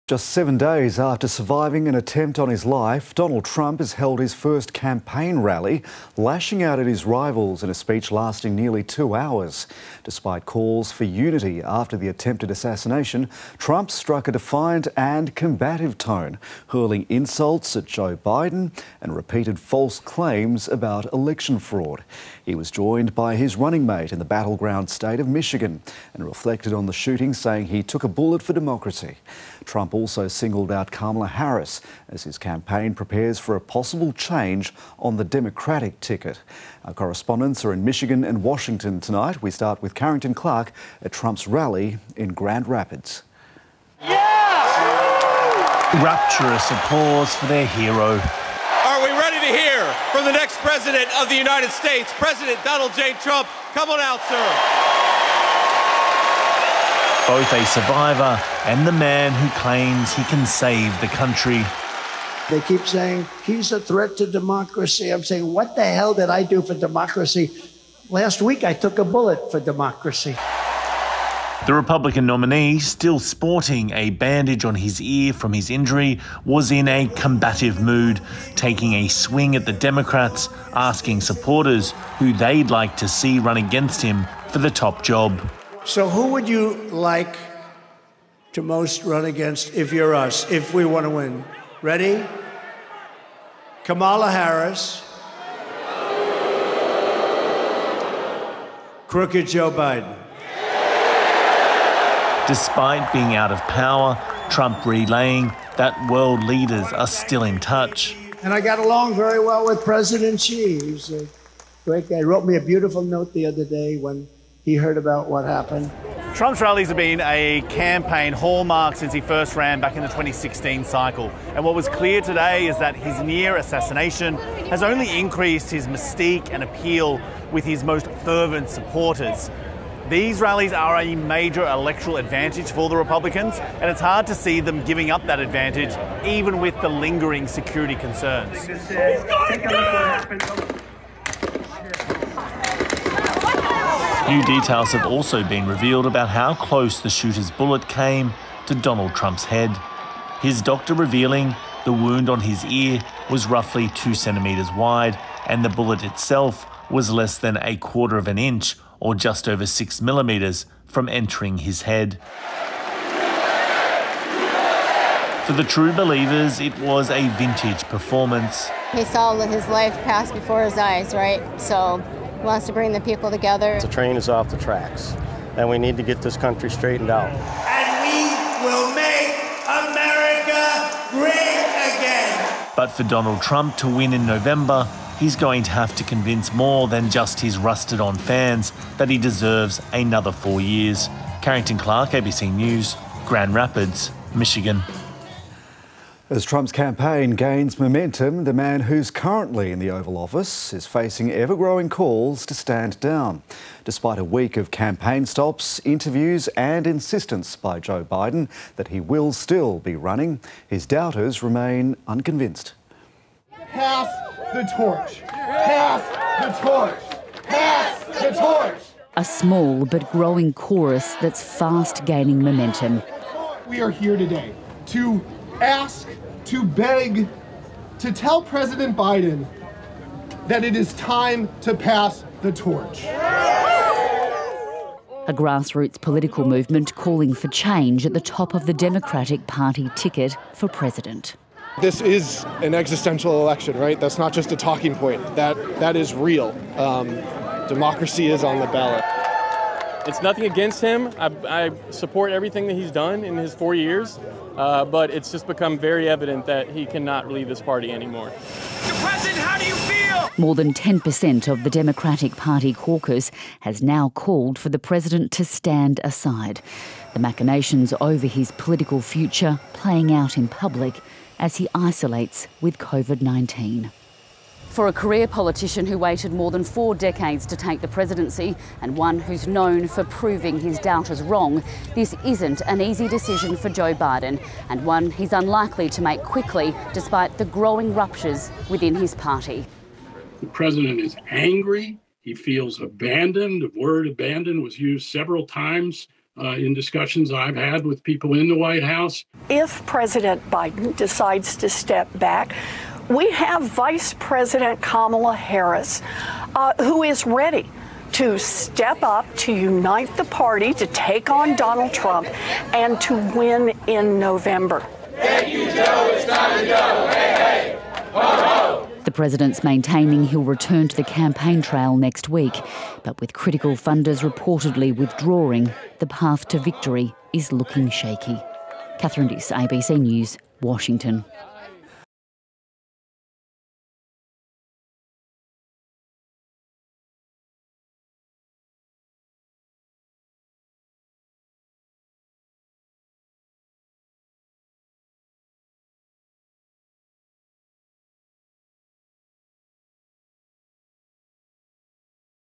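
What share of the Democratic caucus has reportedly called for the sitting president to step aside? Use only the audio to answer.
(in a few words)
More than 10%.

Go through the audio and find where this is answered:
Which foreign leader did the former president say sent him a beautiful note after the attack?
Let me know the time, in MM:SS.
01:49.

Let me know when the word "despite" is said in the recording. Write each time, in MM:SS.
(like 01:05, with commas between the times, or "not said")
00:10, 01:42, 03:23, 04:46.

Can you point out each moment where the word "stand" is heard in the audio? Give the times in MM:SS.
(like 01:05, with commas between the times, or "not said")
03:22, 04:25.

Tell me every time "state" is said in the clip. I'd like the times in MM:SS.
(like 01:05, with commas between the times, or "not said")
00:24, 00:51.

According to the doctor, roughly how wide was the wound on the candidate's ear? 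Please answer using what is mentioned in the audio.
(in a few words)
2 centimetres.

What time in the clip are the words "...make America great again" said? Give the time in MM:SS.
02:58.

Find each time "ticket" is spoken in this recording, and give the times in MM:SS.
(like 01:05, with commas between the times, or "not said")
00:36, 03:59.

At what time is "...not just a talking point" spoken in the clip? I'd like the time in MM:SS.
04:04.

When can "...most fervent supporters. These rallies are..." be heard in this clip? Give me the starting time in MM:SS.
02:07.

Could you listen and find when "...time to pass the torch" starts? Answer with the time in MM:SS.
03:50.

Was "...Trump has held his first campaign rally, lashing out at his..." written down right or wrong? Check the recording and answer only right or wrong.
right.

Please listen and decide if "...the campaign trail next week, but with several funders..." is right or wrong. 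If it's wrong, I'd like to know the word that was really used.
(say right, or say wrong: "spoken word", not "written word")
wrong: "critical", not "several".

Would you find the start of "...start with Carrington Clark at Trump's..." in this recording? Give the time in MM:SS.
00:39.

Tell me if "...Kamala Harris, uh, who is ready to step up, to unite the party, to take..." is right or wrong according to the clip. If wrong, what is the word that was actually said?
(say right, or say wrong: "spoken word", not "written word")
right.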